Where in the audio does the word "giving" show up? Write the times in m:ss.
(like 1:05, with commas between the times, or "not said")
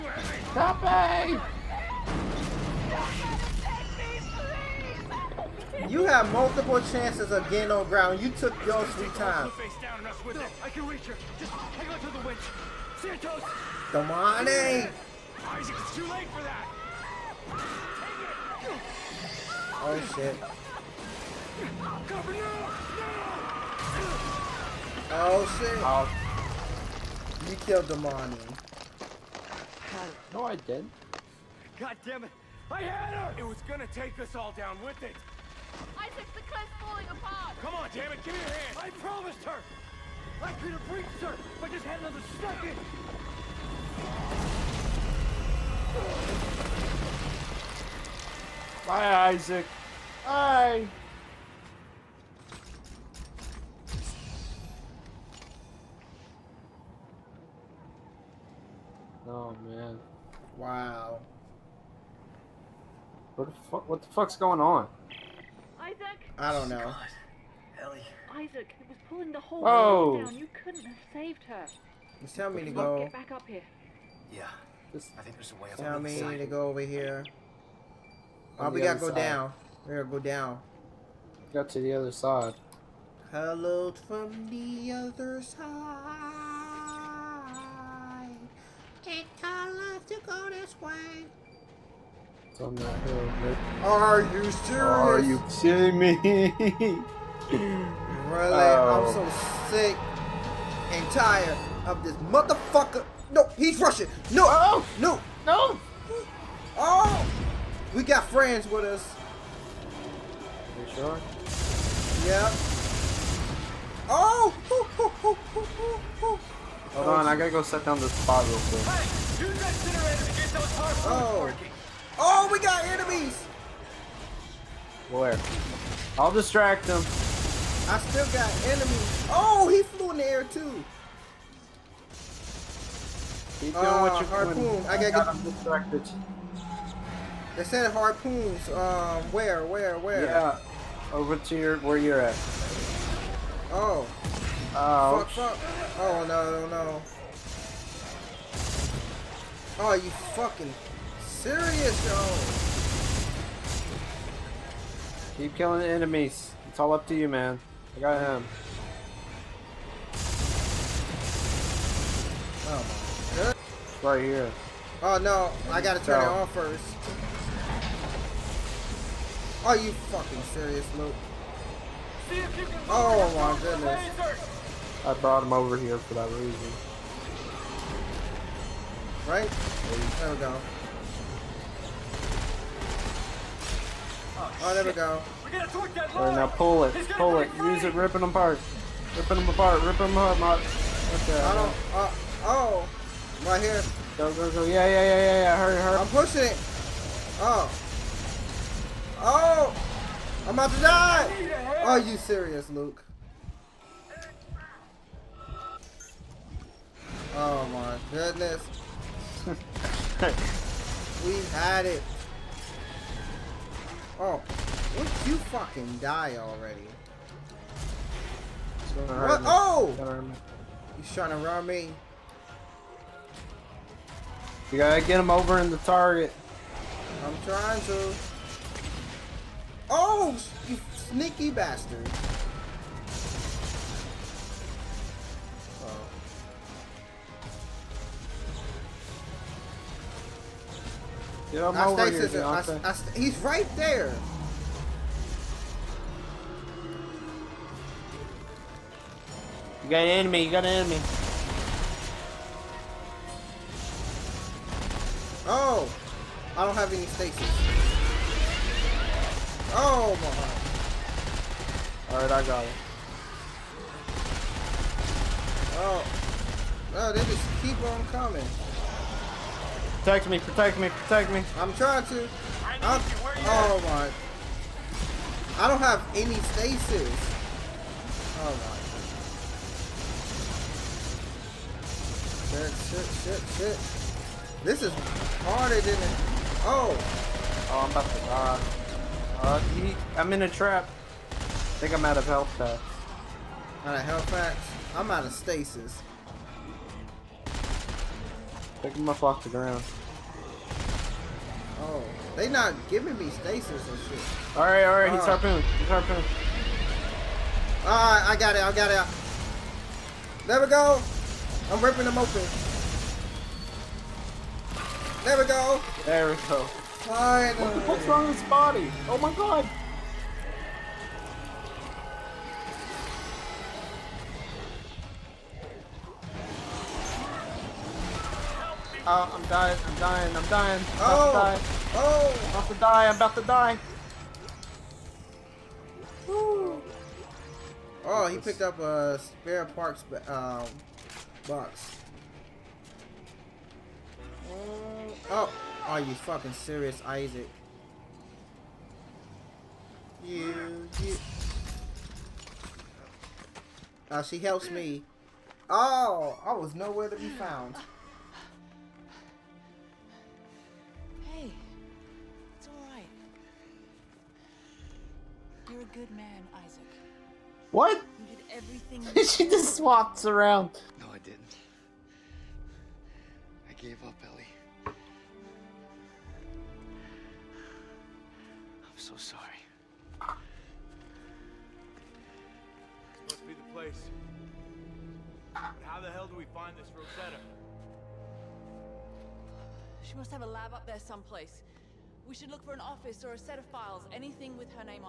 5:02.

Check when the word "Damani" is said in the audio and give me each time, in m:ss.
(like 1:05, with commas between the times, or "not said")
0:13, 0:27.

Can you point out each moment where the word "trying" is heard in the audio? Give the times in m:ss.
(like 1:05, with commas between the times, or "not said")
3:41, 3:47, 4:31.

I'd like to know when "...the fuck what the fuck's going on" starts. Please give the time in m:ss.
1:03.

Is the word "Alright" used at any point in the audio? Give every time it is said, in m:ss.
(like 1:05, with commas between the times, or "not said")
4:22.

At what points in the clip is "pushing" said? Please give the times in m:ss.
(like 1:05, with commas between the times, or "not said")
3:16.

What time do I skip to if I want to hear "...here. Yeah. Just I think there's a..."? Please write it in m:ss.
1:13.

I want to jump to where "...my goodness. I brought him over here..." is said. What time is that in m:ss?
2:53.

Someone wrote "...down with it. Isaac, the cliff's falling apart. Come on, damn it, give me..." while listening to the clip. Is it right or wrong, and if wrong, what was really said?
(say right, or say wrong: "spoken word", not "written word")
right.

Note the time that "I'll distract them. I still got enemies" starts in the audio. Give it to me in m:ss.
2:06.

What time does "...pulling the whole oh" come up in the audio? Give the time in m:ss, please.
1:09.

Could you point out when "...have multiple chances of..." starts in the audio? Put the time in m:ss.
0:06.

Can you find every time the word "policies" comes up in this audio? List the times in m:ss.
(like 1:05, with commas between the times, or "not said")
not said.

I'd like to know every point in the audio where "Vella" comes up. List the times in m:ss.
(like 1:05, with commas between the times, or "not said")
not said.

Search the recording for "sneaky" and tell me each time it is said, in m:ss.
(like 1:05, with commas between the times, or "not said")
3:51.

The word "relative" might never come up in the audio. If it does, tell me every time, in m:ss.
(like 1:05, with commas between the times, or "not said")
not said.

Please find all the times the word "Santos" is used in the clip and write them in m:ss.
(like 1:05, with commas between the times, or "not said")
0:13.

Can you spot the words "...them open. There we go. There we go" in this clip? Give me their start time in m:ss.
5:12.